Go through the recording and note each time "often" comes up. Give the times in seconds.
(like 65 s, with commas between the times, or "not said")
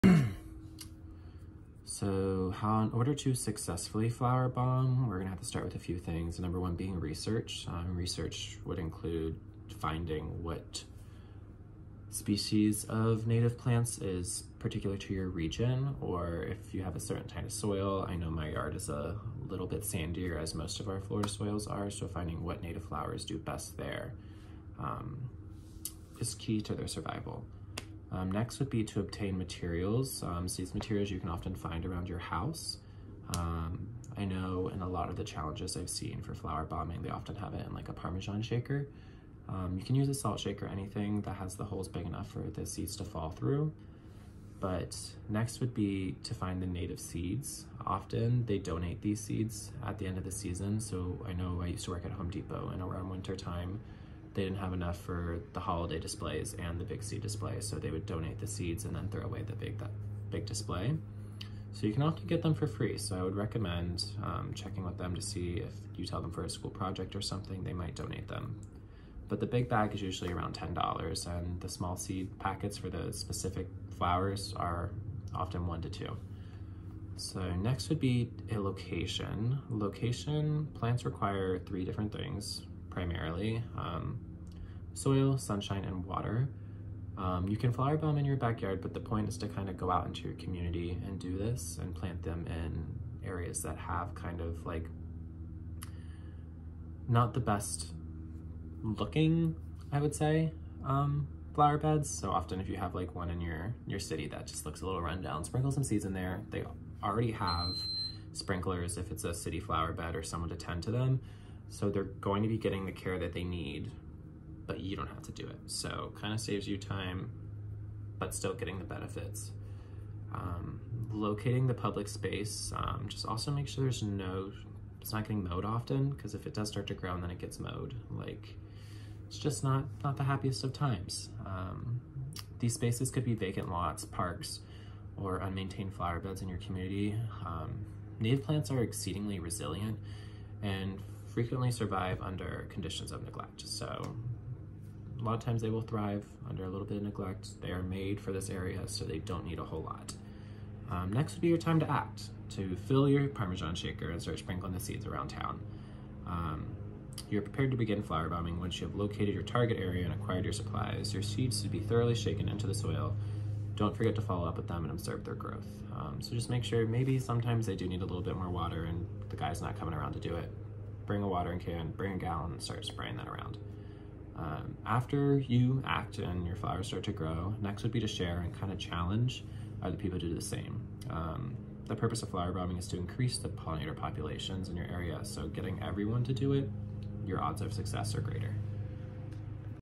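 31 s, 37 s, 47 s, 62 s, 75 s, 102 s, 125 s.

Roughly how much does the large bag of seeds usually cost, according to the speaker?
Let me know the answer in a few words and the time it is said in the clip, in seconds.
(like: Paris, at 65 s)
$10, at 70 s.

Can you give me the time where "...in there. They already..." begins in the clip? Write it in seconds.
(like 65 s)
106 s.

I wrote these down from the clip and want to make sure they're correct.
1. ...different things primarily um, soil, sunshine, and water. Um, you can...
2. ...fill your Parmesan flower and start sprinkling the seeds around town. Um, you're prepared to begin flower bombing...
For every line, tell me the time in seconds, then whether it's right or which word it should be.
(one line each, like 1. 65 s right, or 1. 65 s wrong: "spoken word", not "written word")
1. 81 s right
2. 152 s wrong: "shaker", not "flower".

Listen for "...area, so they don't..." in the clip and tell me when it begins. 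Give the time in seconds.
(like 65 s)
148 s.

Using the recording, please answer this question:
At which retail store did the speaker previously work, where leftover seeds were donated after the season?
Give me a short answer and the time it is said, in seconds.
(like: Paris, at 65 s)
Home Depot, at 52 s.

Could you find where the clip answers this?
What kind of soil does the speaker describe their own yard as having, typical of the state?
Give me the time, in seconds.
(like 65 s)
19 s.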